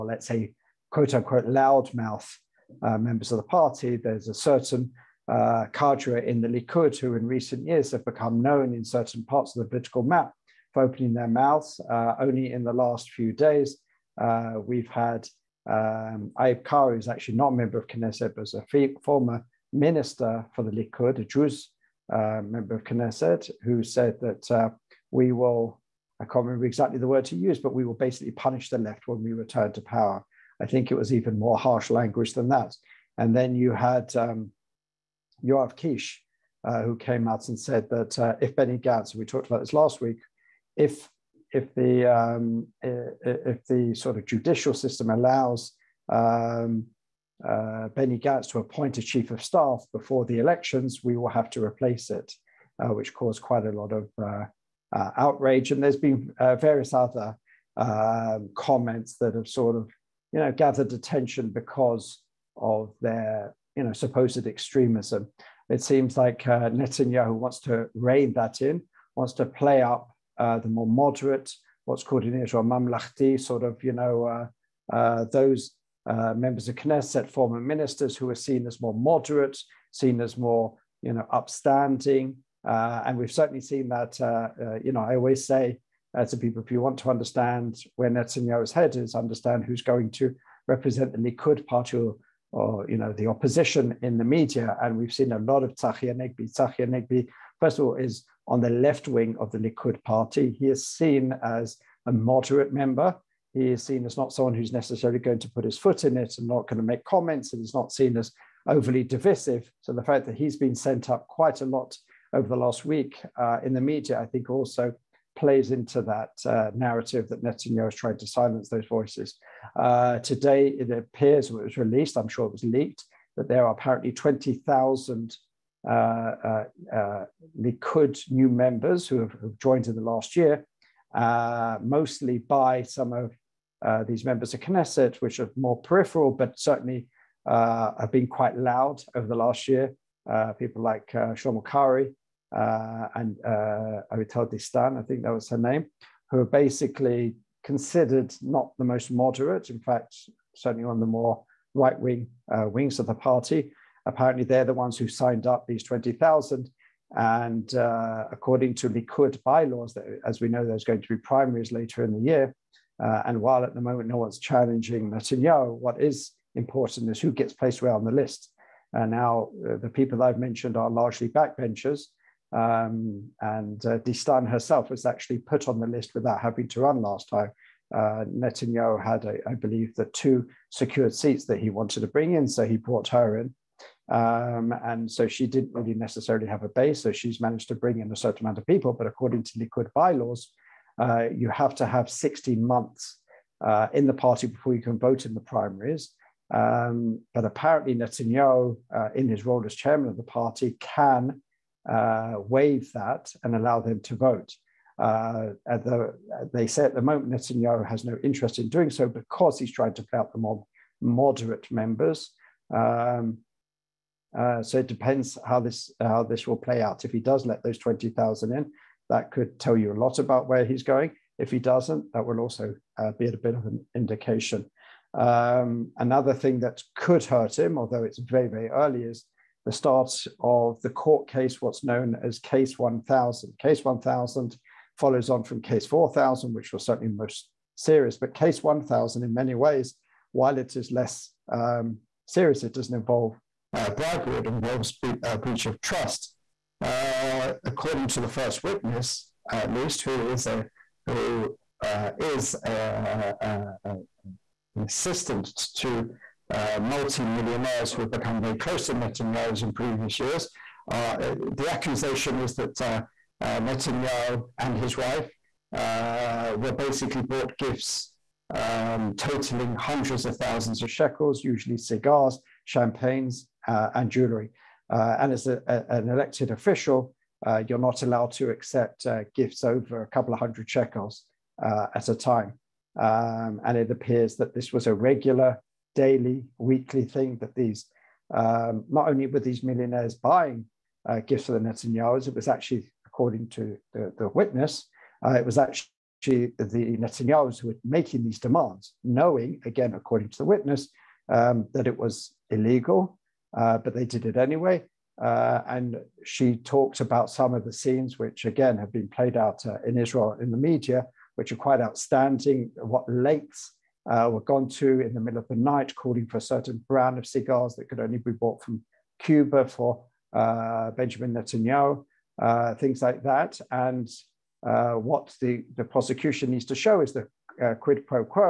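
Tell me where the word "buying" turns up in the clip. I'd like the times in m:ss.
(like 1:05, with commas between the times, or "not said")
4:50.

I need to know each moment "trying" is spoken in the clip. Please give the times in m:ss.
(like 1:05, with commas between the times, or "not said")
1:57, 3:29.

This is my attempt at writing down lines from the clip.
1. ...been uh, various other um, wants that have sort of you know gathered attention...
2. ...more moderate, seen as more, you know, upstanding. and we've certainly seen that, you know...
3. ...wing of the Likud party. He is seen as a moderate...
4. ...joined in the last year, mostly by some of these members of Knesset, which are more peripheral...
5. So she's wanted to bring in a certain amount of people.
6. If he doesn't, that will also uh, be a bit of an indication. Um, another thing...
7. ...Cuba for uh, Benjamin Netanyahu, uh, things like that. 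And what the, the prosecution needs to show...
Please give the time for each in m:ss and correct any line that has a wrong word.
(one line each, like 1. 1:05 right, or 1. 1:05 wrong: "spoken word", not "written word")
1. 0:55 wrong: "comments", not "wants"
2. 1:18 right
3. 1:39 right
4. 2:09 right
5. 3:07 wrong: "managed", not "wanted"
6. 3:41 right
7. 5:19 right.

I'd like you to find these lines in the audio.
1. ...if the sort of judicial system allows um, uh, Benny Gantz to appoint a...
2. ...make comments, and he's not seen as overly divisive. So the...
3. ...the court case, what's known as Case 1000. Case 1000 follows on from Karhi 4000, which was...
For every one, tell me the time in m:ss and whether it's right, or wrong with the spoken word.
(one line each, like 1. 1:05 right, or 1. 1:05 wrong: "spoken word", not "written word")
1. 0:42 right
2. 1:46 right
3. 3:50 wrong: "Case", not "Karhi".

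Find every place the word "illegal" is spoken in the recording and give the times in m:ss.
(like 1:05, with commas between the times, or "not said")
5:02.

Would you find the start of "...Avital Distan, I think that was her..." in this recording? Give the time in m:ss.
2:23.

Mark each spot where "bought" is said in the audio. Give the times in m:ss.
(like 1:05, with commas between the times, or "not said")
4:27, 5:18.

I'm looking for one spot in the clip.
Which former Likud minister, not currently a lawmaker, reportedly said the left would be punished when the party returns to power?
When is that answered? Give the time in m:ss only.
0:16.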